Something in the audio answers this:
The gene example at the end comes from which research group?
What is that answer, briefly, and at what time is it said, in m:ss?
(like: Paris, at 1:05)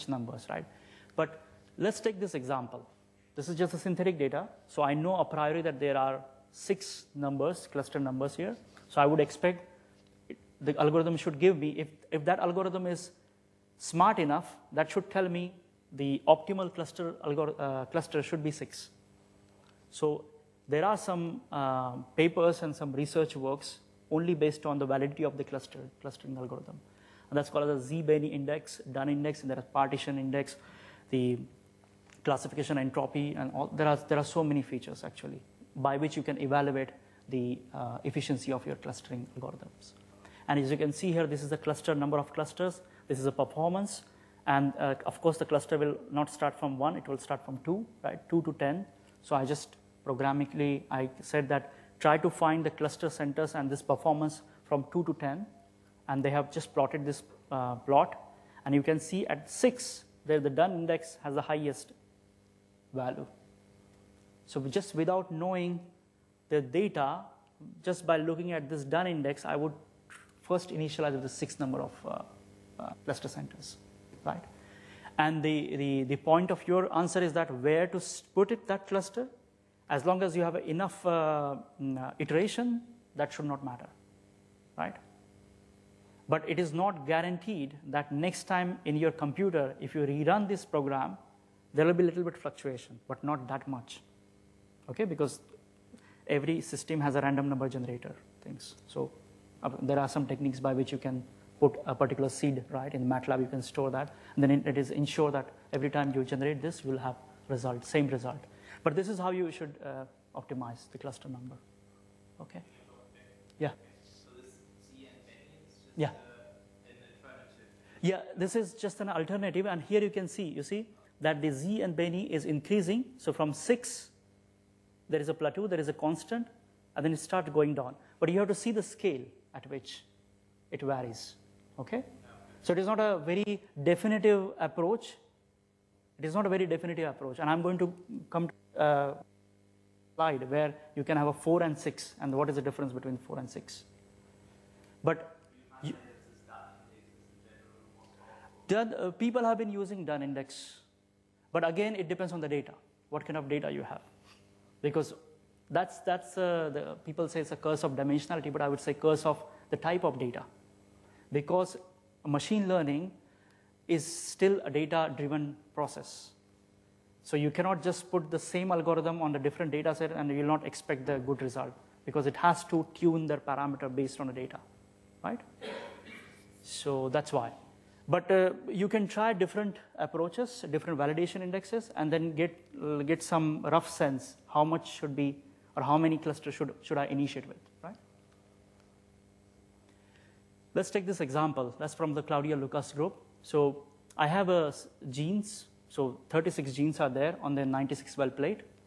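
Claudia Lukas group, at 3:12.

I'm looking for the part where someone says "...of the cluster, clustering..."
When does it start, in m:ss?
0:25.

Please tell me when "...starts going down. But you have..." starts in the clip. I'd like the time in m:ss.
2:07.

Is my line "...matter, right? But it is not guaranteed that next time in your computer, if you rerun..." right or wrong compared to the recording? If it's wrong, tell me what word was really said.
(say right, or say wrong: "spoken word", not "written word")
right.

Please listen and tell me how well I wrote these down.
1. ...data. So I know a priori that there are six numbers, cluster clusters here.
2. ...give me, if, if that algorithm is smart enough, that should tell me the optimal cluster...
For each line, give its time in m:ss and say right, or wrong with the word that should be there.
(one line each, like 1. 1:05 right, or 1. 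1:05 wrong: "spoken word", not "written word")
1. 0:04 wrong: "numbers", not "clusters"
2. 0:11 right.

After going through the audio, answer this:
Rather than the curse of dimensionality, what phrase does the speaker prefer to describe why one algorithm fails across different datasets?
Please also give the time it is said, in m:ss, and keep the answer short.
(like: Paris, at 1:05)
curse of the type of data, at 2:38.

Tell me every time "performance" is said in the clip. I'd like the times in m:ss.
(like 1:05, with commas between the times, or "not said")
0:43, 0:53.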